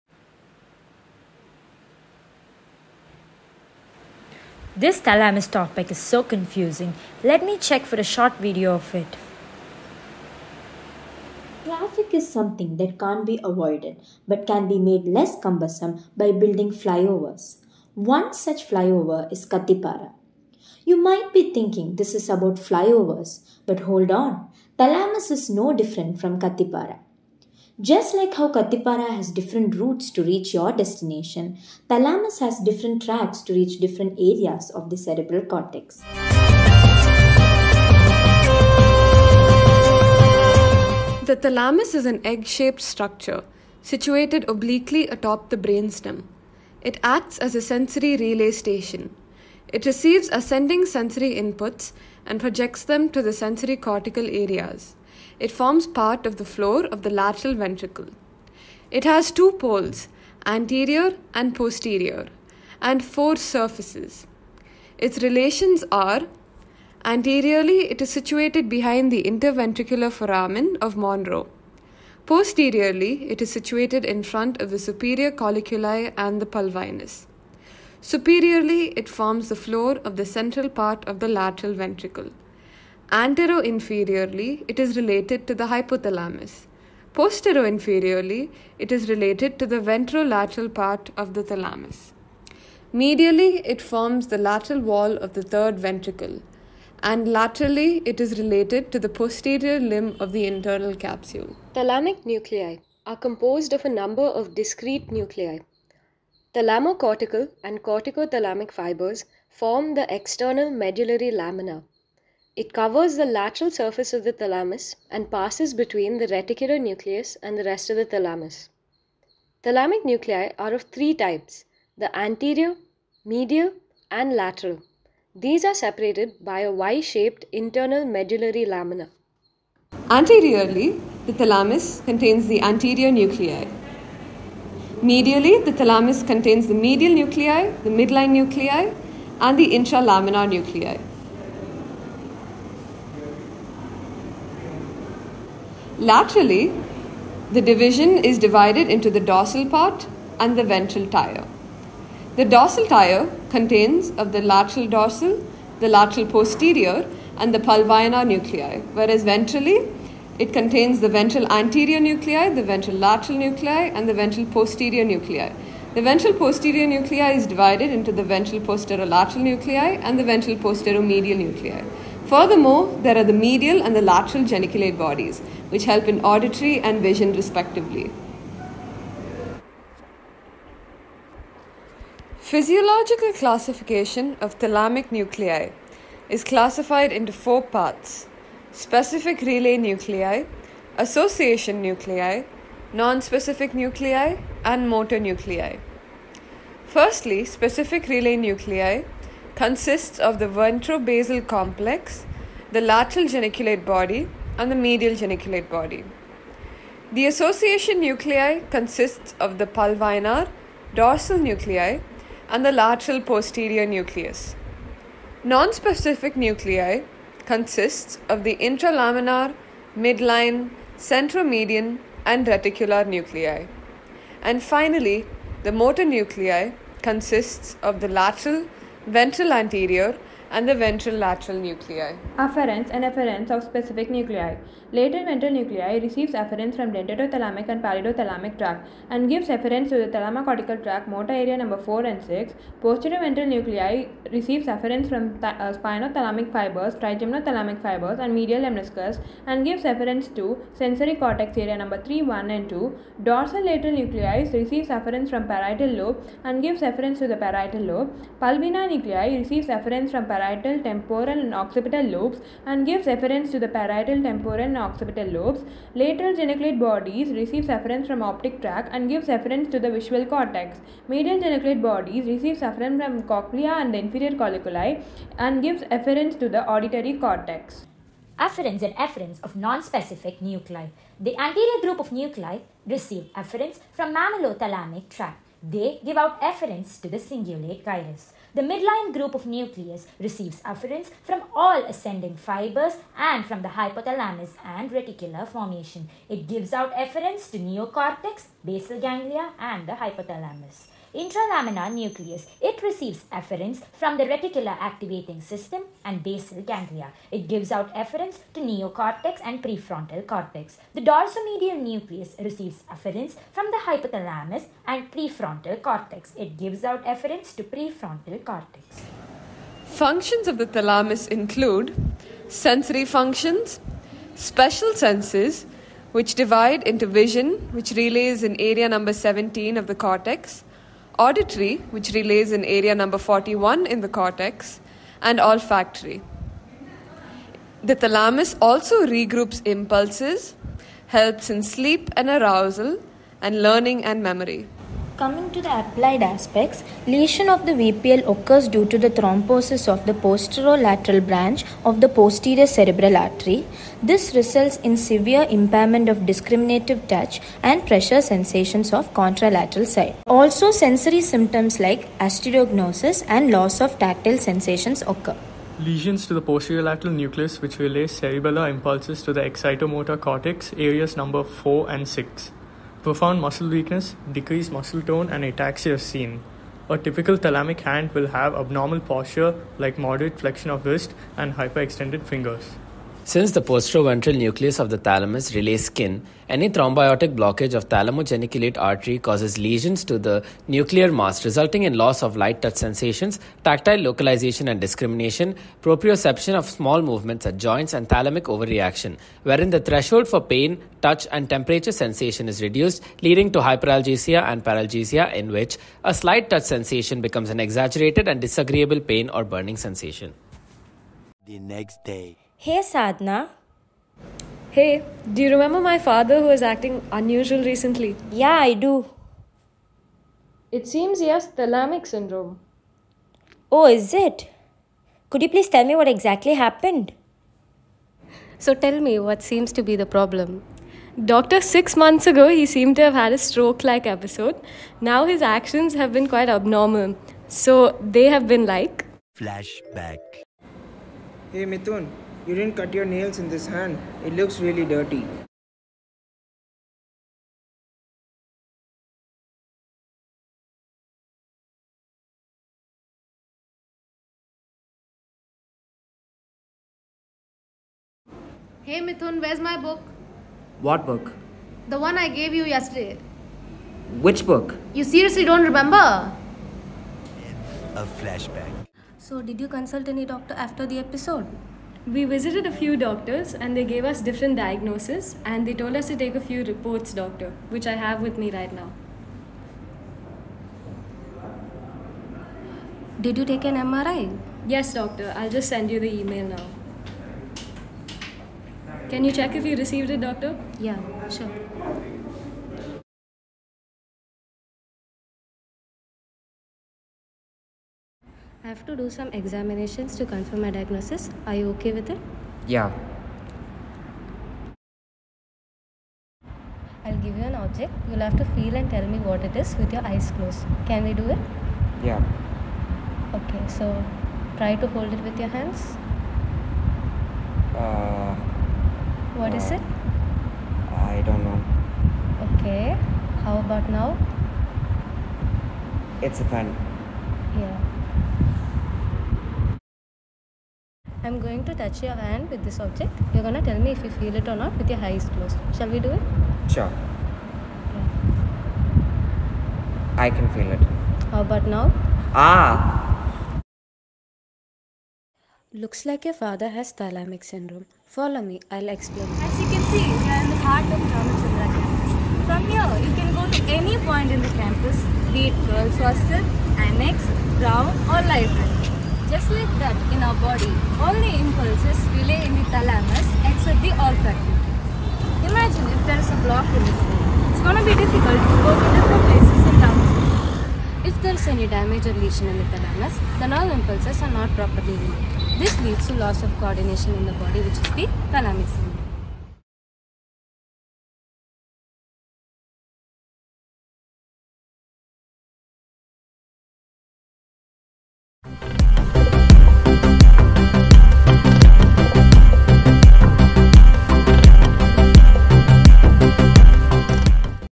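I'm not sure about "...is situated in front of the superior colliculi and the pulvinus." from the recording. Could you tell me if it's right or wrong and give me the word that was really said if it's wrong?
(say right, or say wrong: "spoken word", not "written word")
right.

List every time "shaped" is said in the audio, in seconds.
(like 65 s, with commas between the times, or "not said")
42 s, 126 s.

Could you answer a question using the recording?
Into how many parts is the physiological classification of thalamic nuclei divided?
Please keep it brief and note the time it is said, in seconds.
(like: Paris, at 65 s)
4, at 187 s.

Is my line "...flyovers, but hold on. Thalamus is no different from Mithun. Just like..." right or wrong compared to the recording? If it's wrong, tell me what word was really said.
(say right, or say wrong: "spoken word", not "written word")
wrong: "Kathipara", not "Mithun".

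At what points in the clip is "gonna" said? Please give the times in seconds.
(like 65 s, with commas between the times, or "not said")
533 s, 567 s.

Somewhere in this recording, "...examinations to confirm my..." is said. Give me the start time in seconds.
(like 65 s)
499 s.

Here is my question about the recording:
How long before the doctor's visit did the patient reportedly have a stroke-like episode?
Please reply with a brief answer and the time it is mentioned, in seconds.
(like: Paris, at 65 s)
6 months, at 431 s.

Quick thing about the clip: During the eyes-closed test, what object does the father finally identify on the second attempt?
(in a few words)
A pen.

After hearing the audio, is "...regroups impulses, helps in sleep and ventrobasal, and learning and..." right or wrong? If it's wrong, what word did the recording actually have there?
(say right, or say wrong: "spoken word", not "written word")
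wrong: "arousal", not "ventrobasal".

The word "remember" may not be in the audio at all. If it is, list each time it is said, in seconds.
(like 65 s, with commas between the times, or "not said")
415 s, 465 s.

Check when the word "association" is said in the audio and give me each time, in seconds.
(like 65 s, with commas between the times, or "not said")
190 s, 207 s.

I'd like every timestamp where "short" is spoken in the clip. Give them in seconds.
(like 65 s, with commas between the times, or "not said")
8 s.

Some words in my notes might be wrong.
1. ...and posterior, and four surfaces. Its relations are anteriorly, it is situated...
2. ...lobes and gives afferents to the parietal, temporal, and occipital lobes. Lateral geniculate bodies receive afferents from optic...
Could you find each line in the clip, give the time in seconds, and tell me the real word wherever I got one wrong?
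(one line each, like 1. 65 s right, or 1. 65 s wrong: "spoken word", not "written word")
1. 61 s right
2. 262 s right.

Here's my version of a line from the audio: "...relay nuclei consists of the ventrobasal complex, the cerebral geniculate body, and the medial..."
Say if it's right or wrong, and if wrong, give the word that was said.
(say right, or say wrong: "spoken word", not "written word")
wrong: "lateral", not "cerebral".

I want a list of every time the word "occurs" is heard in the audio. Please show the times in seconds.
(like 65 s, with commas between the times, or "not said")
348 s, 365 s.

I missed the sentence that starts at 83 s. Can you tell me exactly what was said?
Anteroinferiorly, it is related to the hypothalamus.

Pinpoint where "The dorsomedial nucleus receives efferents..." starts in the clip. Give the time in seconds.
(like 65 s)
310 s.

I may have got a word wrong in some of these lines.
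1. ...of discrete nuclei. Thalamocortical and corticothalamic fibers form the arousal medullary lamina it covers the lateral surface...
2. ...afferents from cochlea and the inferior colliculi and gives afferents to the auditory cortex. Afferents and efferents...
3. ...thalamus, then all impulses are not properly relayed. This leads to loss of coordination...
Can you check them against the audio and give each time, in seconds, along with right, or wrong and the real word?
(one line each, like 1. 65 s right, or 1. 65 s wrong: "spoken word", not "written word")
1. 104 s wrong: "external", not "arousal"
2. 272 s right
3. 572 s right.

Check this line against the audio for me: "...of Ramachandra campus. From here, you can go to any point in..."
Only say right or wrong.
right.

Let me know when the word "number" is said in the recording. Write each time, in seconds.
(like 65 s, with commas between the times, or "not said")
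103 s, 241 s, 251 s, 328 s, 332 s, 371 s.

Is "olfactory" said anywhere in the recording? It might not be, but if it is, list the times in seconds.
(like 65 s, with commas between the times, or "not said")
335 s, 563 s.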